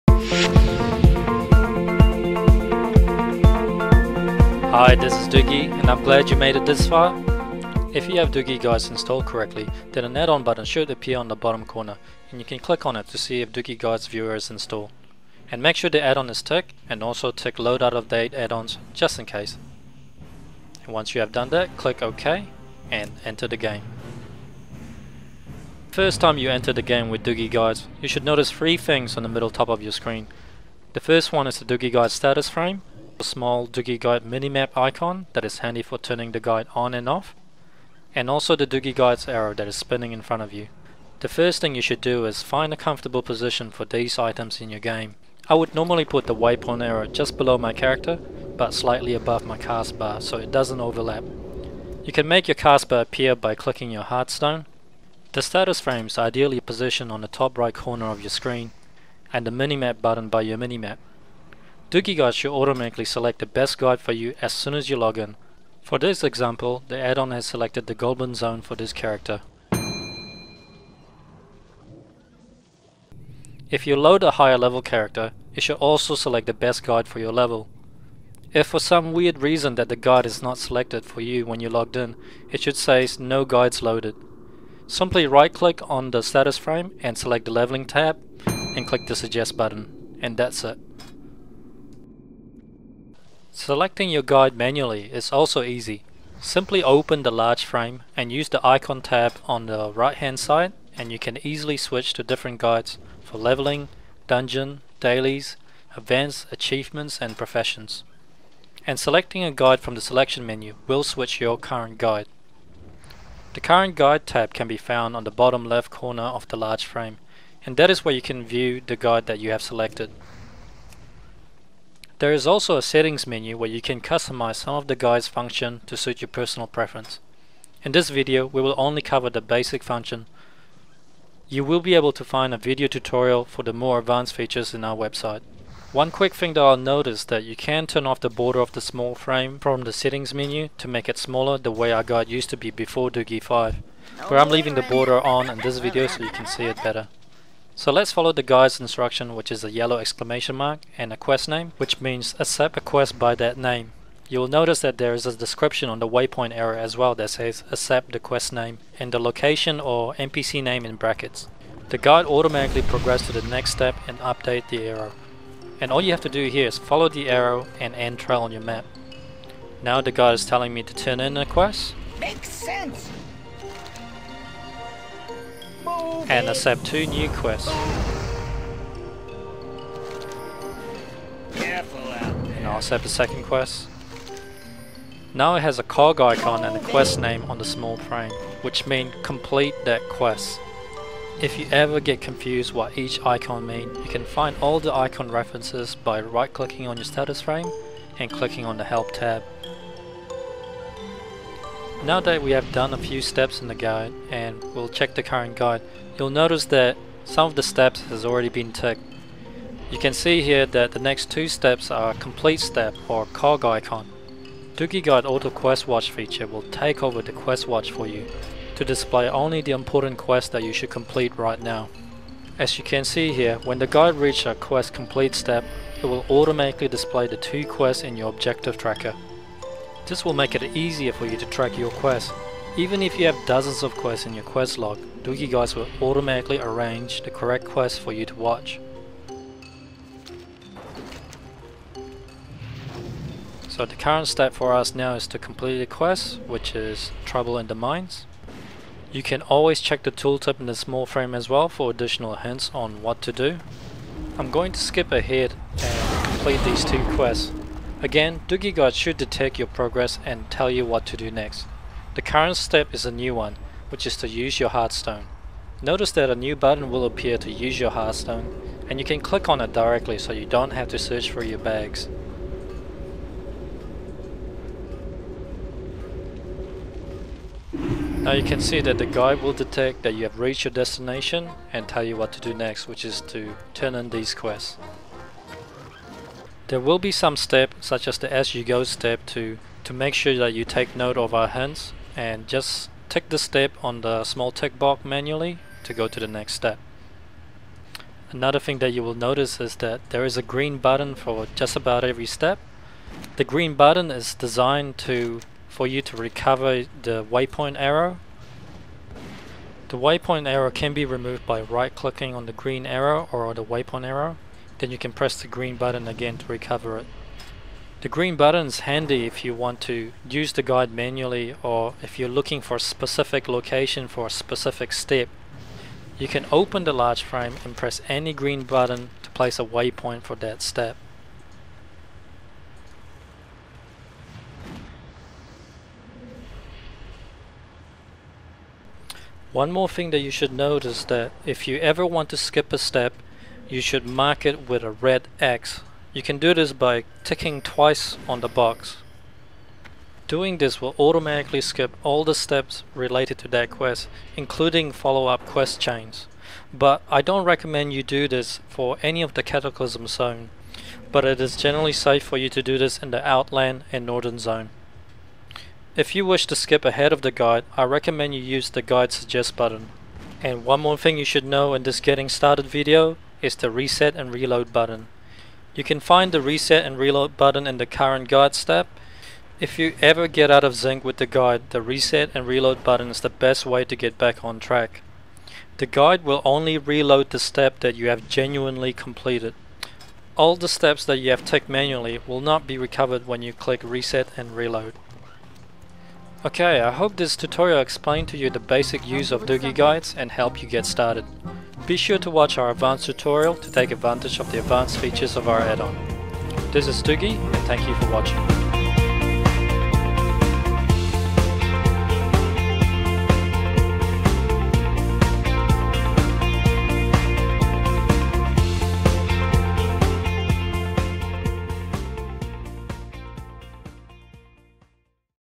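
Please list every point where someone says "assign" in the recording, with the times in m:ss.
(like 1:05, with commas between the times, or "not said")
not said.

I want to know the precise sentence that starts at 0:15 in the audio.
And make sure the add-on is ticked and also tick load out of date add-ons just in case.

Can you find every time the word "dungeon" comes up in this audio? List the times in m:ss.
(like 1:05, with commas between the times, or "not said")
1:44.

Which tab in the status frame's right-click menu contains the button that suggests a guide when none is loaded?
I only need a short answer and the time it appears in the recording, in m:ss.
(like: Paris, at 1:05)
Leveling tab, at 1:27.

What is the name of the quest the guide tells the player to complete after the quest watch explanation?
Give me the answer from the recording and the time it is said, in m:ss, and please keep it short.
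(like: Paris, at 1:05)
Trouble in the Mines, at 4:07.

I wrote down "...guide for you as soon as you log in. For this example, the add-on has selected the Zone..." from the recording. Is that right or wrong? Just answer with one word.
wrong.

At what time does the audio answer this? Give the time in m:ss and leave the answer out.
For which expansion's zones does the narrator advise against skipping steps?
5:59.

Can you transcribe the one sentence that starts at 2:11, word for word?
You will be able to find a video tutorial for the more advanced features in our website.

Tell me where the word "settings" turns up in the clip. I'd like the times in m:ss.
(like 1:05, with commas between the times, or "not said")
2:02, 2:19.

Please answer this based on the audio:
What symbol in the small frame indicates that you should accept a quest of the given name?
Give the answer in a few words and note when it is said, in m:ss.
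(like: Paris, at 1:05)
Yellow exclamation mark, at 2:29.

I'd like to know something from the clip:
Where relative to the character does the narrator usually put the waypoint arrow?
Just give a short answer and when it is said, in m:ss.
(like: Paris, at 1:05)
Just below my character, at 0:47.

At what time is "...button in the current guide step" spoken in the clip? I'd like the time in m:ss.
6:17.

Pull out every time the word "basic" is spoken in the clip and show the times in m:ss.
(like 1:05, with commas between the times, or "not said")
2:09, 6:38.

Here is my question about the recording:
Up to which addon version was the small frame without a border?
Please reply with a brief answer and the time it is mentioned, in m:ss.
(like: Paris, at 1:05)
Dugi 5, at 2:23.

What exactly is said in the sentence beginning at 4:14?
I'm going to skip ahead and complete these two quests.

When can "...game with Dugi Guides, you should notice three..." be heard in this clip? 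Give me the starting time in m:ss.
0:26.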